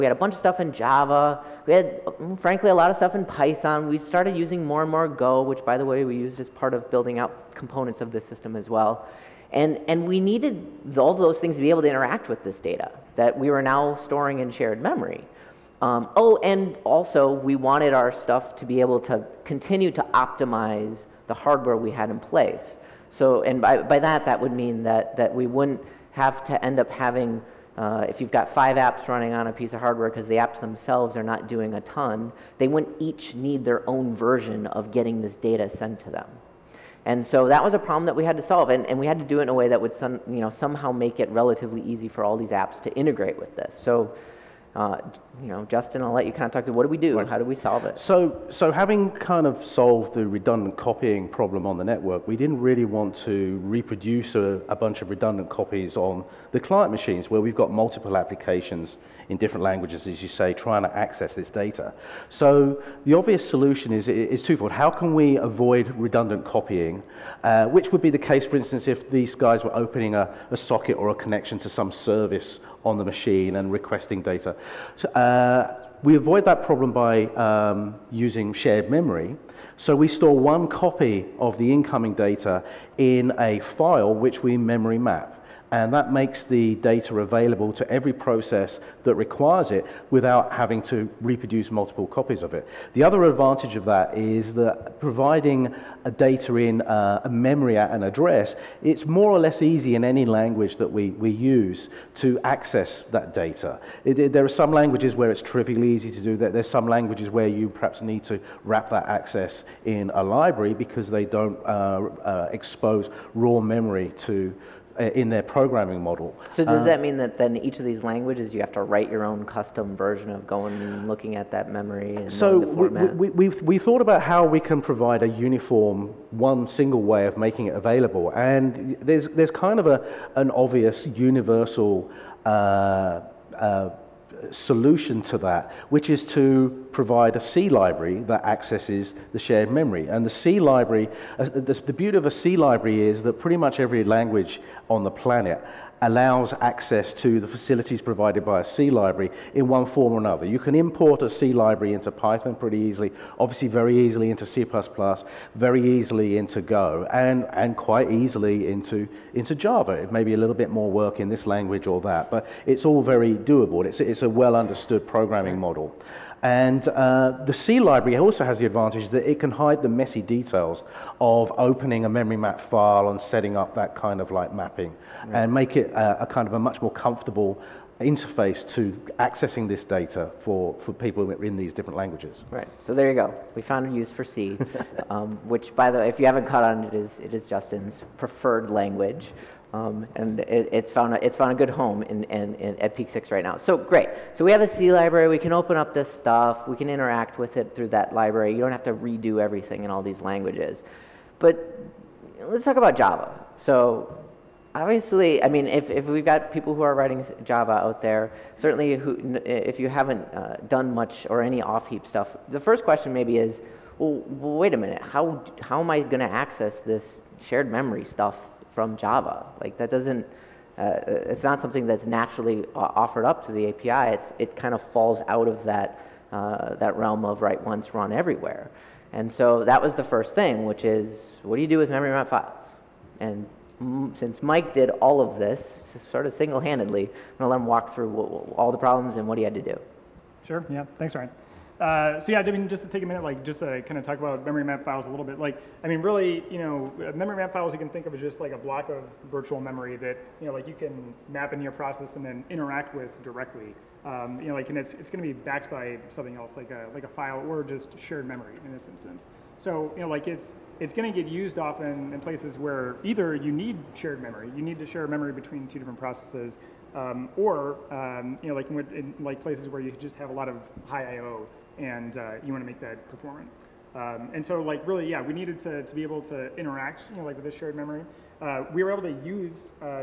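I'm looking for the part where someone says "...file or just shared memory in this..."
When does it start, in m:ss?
4:17.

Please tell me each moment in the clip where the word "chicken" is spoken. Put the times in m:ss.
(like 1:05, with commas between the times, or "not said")
not said.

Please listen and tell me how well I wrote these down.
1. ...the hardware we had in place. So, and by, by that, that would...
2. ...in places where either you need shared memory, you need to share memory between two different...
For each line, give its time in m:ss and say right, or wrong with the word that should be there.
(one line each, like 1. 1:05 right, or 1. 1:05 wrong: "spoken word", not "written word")
1. 0:21 right
2. 4:22 right.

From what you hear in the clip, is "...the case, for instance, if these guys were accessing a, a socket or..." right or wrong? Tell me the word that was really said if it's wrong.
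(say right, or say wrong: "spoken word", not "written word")
wrong: "opening", not "accessing".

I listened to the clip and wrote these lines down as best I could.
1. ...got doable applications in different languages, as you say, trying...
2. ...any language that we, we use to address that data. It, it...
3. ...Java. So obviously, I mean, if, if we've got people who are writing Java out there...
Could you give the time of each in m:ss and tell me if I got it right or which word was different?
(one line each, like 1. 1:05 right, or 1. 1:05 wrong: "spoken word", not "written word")
1. 0:57 wrong: "multiple", not "doable"
2. 1:40 wrong: "access", not "address"
3. 3:22 right.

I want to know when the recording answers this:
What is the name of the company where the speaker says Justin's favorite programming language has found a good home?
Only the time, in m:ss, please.
3:12.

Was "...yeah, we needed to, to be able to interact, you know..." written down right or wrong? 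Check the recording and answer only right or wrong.
right.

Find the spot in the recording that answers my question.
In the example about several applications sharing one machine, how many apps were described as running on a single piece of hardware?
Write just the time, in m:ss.
0:28.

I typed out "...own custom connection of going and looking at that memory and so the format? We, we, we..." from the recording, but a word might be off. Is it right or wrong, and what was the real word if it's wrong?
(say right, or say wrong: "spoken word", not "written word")
wrong: "version", not "connection".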